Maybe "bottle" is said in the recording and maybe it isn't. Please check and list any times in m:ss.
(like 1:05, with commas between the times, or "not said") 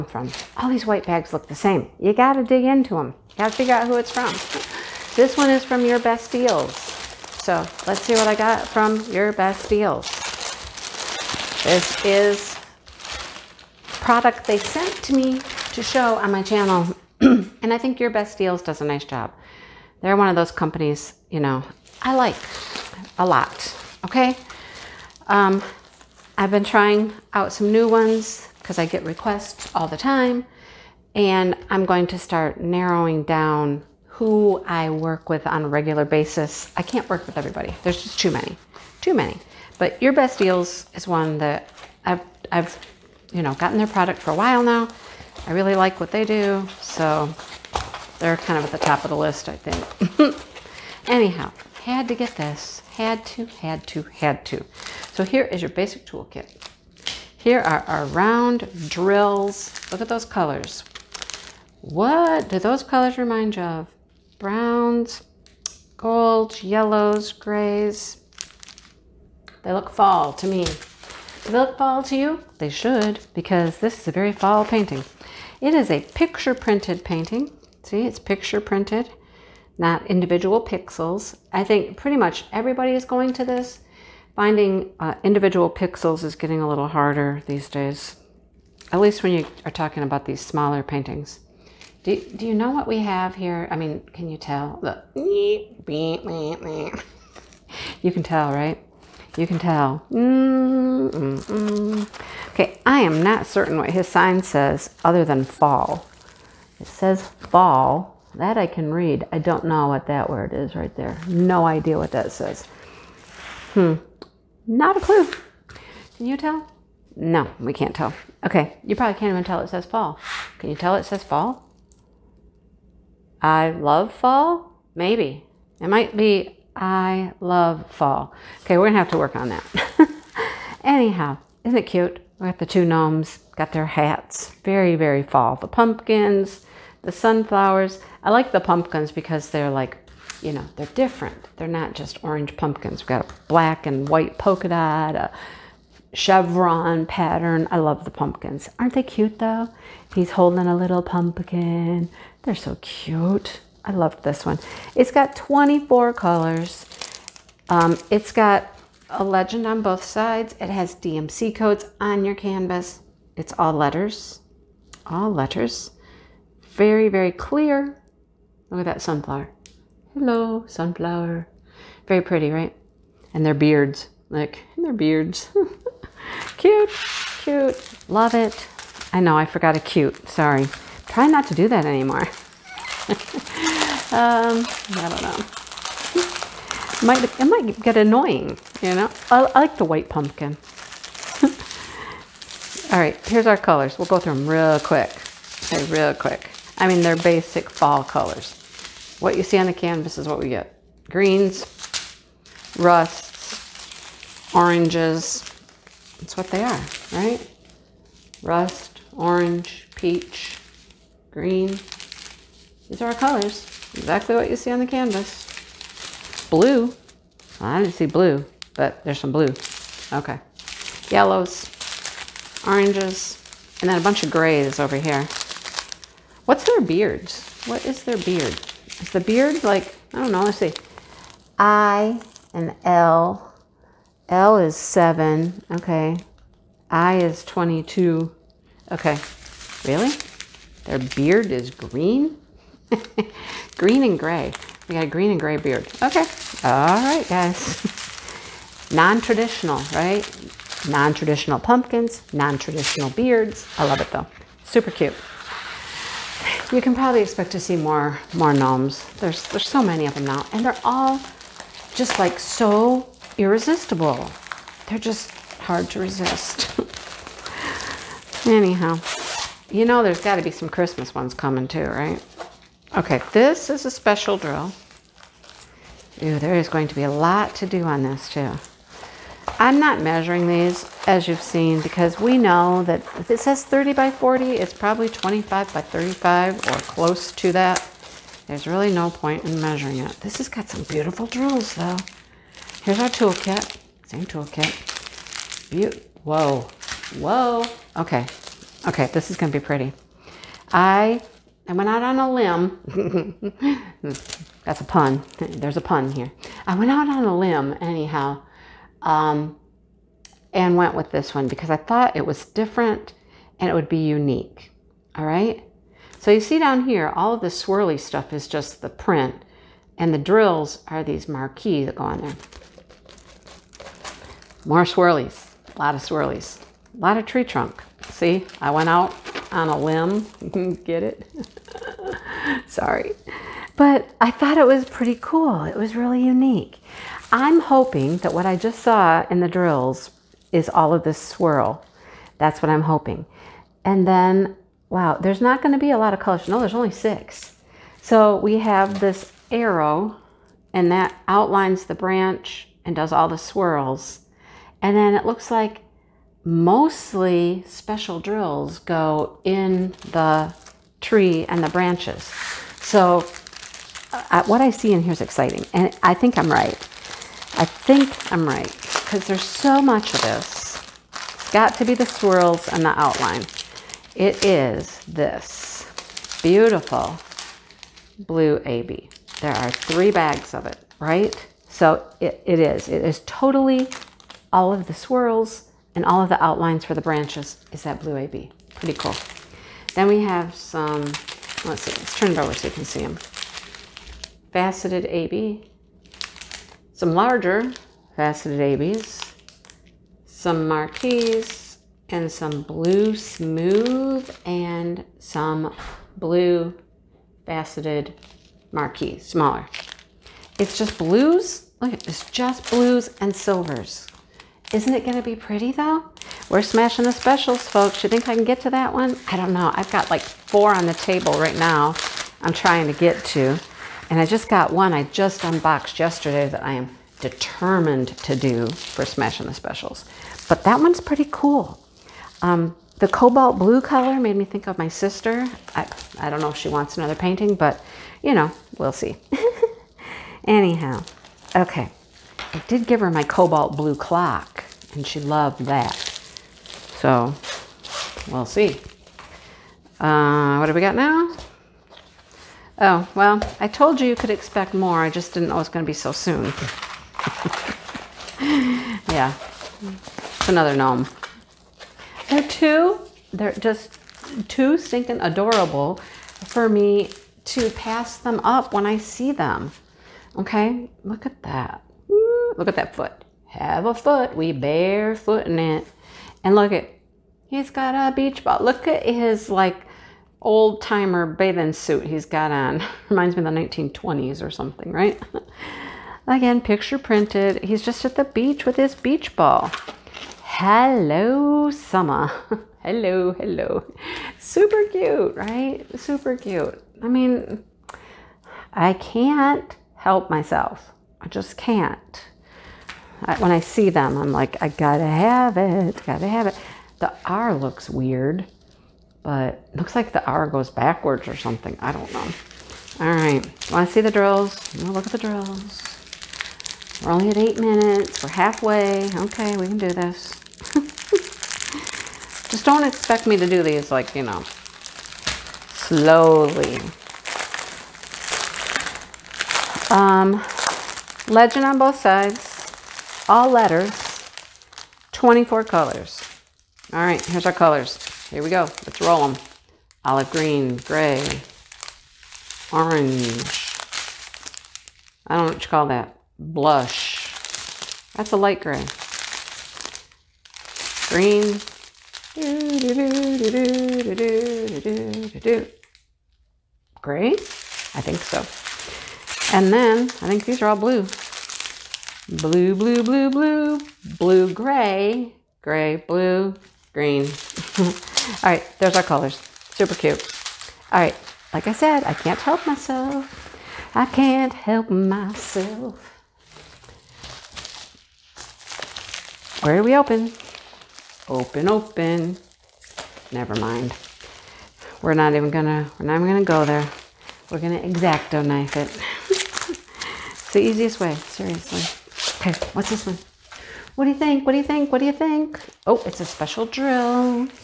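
not said.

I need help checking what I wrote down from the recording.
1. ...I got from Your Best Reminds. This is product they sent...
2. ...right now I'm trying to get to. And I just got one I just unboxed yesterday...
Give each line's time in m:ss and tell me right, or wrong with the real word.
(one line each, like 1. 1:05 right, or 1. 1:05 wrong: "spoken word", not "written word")
1. 0:08 wrong: "Deals", not "Reminds"
2. 7:01 right.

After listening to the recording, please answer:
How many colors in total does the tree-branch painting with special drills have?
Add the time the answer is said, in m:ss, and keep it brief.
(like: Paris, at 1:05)
6, at 5:46.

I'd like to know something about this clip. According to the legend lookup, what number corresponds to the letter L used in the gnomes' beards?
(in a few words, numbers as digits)
7.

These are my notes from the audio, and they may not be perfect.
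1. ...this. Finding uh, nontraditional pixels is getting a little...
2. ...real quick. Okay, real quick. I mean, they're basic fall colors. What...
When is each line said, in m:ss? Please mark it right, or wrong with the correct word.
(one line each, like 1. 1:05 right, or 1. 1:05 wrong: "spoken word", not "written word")
1. 1:23 wrong: "individual", not "nontraditional"
2. 3:14 right.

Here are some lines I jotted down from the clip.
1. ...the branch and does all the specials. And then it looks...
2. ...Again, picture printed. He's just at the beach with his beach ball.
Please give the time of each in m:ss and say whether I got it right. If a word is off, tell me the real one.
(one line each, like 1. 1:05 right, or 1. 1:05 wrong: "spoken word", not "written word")
1. 5:51 wrong: "swirls", not "specials"
2. 8:06 right.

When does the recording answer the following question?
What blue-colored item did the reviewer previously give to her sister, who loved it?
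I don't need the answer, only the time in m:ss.
7:23.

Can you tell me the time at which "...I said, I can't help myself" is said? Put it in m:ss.
9:31.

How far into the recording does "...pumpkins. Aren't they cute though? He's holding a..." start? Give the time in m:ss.
2:28.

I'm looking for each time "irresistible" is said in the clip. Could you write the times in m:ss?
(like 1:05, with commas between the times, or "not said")
4:23.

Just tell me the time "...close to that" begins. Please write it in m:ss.
4:46.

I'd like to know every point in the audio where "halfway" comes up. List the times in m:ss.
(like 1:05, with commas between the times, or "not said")
8:38.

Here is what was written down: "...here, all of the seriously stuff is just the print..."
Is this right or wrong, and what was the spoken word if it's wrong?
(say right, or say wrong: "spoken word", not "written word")
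wrong: "swirly", not "seriously".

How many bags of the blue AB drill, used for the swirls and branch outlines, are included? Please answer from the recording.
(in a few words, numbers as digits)
3.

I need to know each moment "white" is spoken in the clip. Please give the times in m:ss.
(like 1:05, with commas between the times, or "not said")
0:00, 2:24, 3:09.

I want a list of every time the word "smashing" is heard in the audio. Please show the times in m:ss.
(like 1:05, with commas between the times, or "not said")
6:56, 7:09.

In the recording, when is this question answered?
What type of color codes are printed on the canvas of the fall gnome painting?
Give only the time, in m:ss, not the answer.
2:40.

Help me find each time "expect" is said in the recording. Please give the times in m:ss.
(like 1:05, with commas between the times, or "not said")
4:17, 7:34, 8:42.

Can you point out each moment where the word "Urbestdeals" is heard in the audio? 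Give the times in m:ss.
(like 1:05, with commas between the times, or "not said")
0:40.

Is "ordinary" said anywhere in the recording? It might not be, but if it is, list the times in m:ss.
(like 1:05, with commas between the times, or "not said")
not said.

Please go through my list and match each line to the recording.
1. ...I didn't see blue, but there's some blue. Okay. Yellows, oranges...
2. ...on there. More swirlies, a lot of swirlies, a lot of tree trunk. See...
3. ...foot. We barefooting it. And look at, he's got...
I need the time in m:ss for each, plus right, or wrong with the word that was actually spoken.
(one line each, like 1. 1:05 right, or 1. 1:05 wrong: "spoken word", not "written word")
1. 3:37 right
2. 5:22 right
3. 7:53 right.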